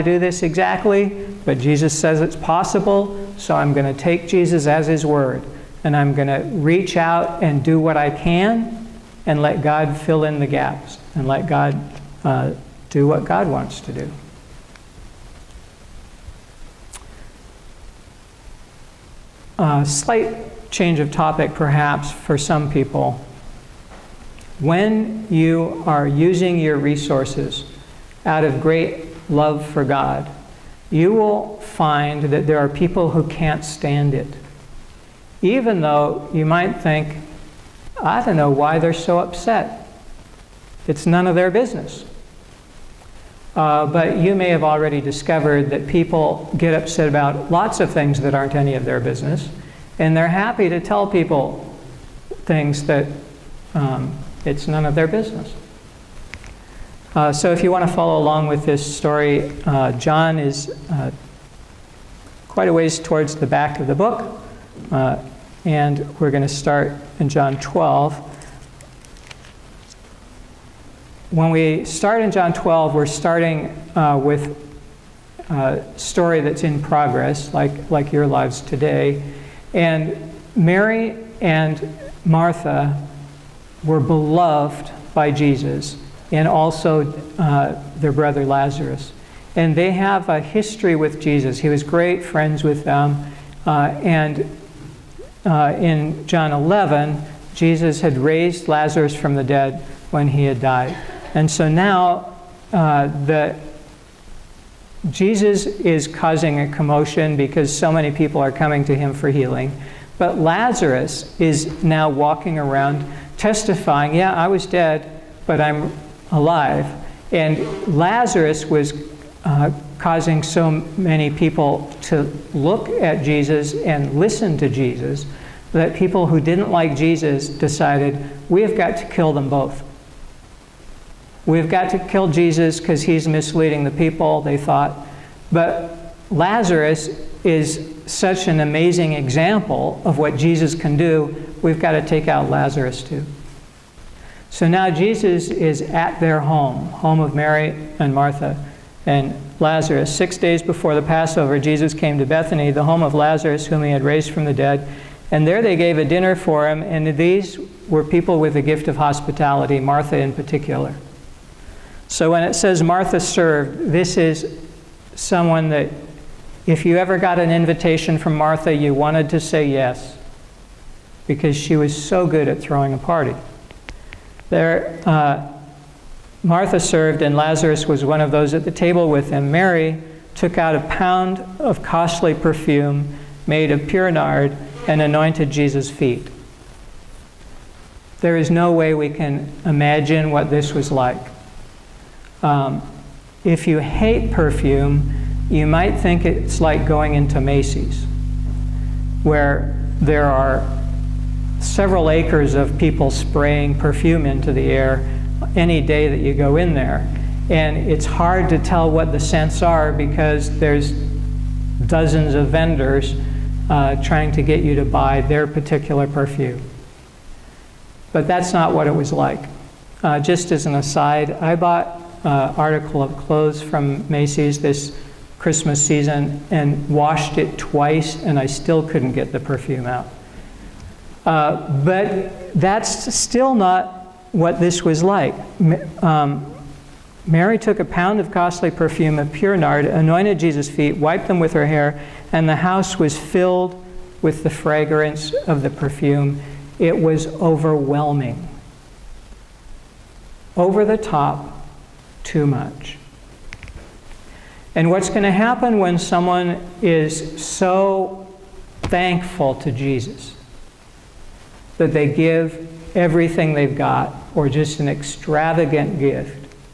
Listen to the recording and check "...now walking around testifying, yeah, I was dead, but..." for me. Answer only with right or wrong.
right.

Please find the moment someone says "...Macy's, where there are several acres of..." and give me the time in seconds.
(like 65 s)
197 s.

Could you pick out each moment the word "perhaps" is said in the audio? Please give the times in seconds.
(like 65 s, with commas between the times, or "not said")
21 s.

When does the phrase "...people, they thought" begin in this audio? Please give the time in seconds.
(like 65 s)
133 s.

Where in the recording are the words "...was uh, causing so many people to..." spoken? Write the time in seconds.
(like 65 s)
118 s.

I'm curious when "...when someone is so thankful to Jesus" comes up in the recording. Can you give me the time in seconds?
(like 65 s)
255 s.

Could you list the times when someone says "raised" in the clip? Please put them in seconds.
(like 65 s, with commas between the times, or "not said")
98 s, 154 s.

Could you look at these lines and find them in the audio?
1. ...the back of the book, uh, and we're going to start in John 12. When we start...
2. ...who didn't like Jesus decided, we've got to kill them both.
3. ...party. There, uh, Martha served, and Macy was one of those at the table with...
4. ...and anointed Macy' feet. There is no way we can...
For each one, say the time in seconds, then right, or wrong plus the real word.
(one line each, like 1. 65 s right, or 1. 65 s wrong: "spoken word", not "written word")
1. 63 s right
2. 126 s right
3. 172 s wrong: "Lazarus", not "Macy"
4. 184 s wrong: "Jesus", not "Macy".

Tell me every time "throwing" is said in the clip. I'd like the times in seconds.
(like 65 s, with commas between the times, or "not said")
172 s.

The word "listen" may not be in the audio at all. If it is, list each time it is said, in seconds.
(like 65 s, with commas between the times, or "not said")
124 s.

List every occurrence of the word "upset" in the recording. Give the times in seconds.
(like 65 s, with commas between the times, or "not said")
39 s, 46 s.